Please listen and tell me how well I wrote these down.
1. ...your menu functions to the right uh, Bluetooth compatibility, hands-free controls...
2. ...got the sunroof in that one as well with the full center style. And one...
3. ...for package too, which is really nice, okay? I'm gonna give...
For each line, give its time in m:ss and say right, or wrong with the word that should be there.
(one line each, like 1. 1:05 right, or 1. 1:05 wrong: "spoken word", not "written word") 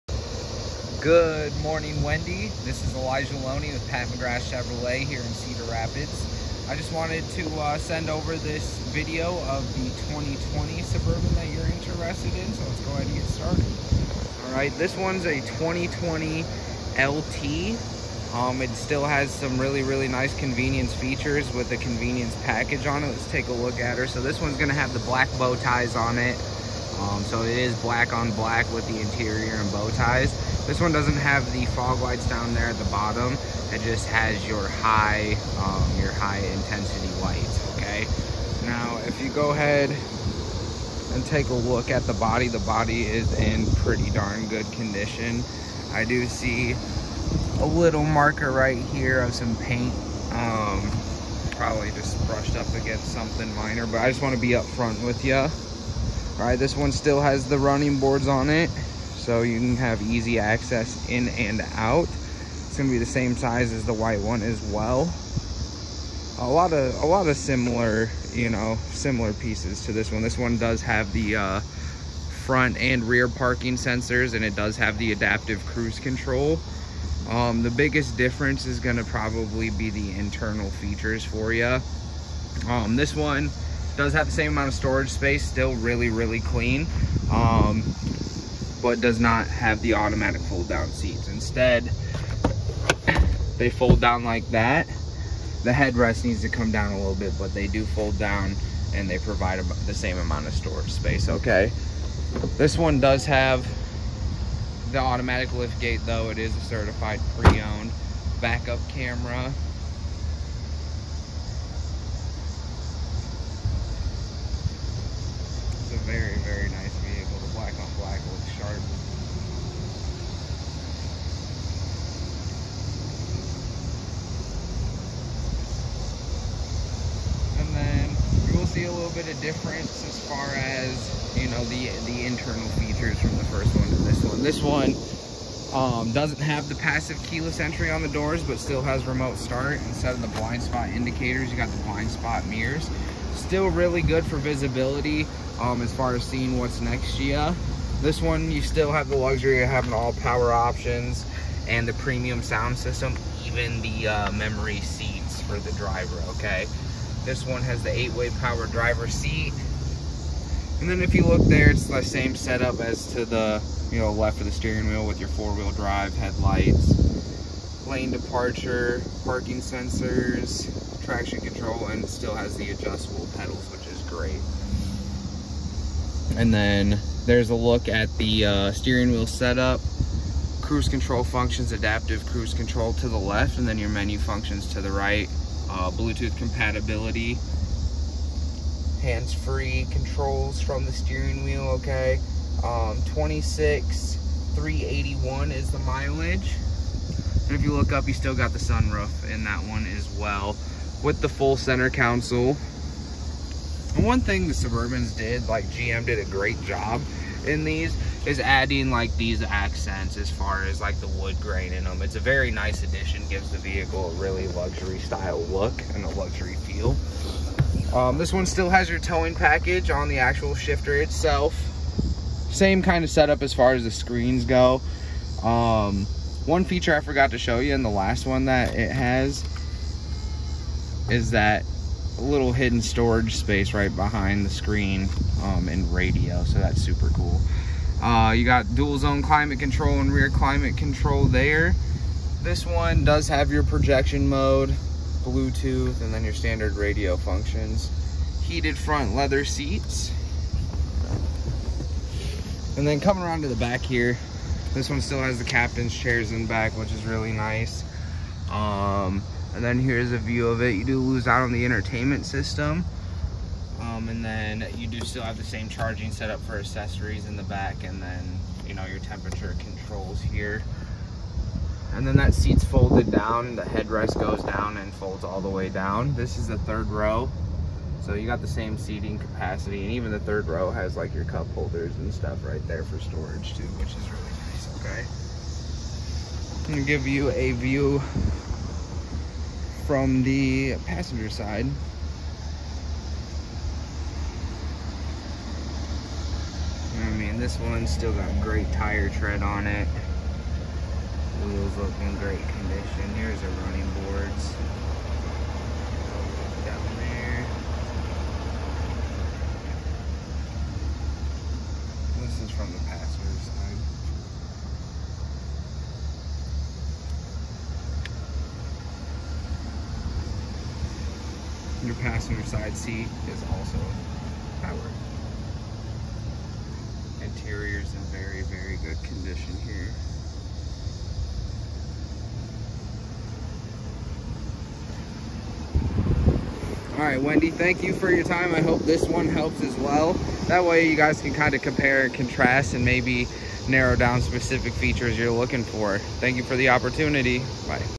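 1. 3:03 right
2. 3:18 wrong: "console", not "style"
3. 4:42 wrong: "storage", not "package".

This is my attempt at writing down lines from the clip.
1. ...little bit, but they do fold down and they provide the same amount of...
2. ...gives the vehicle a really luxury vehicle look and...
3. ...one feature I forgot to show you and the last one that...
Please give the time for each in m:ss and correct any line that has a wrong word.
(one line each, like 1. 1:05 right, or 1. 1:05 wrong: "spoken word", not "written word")
1. 1:36 right
2. 3:33 wrong: "style", not "vehicle"
3. 3:46 right.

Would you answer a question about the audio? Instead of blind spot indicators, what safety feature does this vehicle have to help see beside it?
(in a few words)
blind spot mirrors.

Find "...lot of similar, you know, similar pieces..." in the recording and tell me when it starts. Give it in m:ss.
1:07.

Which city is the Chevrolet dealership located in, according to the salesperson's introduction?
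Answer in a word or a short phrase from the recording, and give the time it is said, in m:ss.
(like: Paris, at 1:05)
Cedar Rapids, at 0:05.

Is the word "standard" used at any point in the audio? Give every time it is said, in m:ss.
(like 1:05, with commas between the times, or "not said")
4:06.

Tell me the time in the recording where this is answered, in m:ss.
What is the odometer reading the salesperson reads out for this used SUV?
3:13.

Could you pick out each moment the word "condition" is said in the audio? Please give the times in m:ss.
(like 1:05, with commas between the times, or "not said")
0:44, 5:02, 5:29.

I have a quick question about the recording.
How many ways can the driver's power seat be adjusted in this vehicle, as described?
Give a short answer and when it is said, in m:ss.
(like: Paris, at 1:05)
8, at 2:37.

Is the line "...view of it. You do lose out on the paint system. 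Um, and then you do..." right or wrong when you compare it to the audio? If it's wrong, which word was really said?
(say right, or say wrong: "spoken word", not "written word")
wrong: "entertainment", not "paint".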